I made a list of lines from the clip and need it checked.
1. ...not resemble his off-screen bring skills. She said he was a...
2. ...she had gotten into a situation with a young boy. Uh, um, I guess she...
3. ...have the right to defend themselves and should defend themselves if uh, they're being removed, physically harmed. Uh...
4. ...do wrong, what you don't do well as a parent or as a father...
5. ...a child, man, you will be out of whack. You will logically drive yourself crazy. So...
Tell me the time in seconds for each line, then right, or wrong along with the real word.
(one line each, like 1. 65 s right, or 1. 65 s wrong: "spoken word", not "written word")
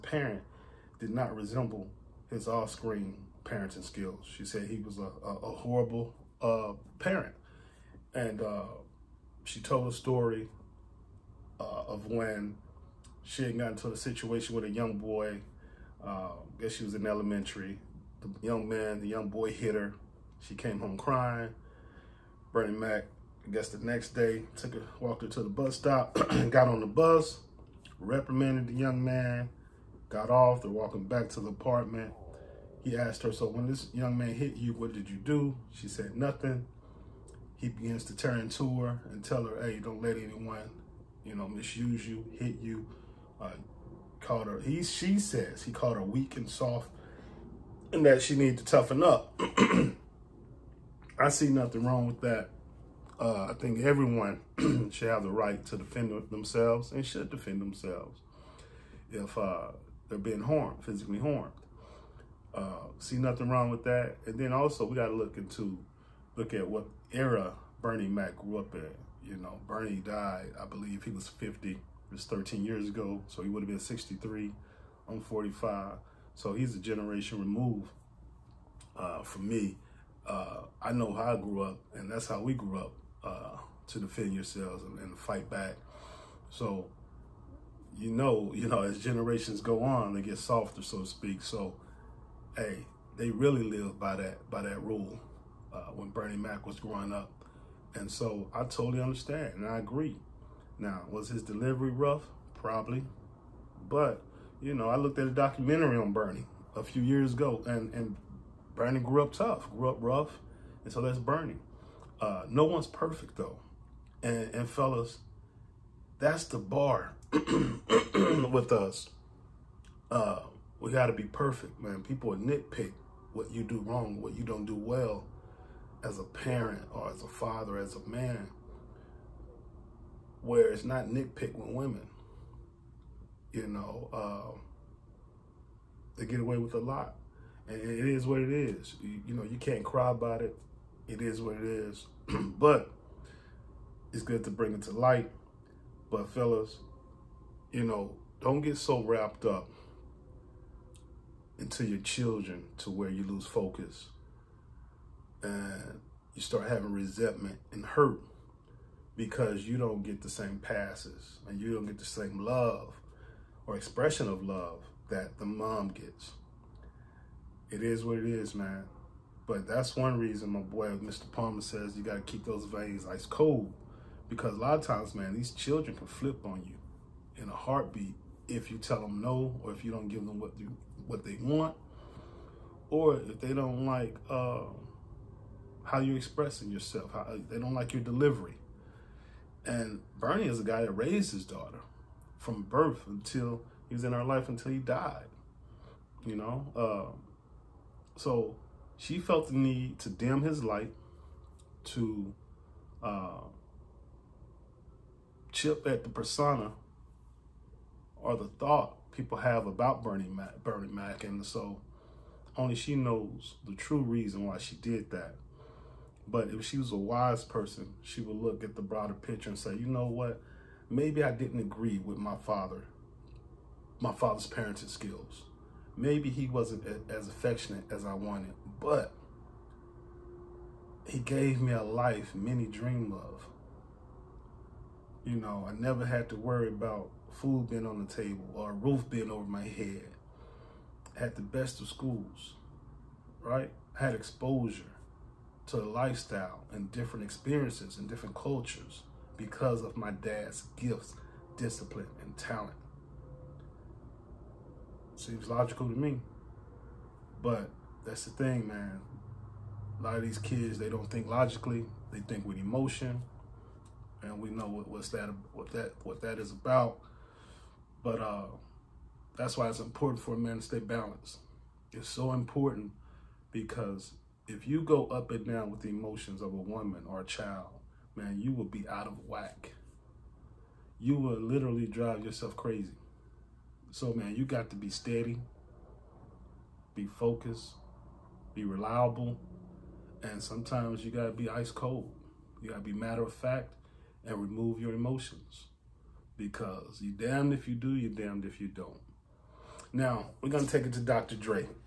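1. 1 s wrong: "parenting", not "bring"
2. 13 s right
3. 55 s wrong: "harmed", not "removed"
4. 123 s right
5. 277 s wrong: "literally", not "logically".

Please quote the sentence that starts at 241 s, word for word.
I had the best of schools, right?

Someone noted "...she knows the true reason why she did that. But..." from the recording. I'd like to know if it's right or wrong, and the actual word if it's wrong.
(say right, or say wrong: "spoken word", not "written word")
right.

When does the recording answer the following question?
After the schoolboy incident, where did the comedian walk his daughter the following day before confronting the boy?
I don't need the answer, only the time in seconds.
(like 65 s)
25 s.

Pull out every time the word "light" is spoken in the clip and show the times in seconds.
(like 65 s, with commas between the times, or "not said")
144 s, 200 s.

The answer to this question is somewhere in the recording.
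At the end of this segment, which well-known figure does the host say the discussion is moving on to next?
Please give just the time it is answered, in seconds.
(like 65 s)
300 s.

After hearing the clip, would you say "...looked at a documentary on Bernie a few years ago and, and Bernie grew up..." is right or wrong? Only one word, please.
right.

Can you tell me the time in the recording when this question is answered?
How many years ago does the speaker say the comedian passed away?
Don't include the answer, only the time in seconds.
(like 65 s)
72 s.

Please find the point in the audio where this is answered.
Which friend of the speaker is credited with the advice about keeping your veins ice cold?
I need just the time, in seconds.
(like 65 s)
170 s.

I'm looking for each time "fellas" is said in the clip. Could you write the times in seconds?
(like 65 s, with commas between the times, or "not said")
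114 s, 146 s.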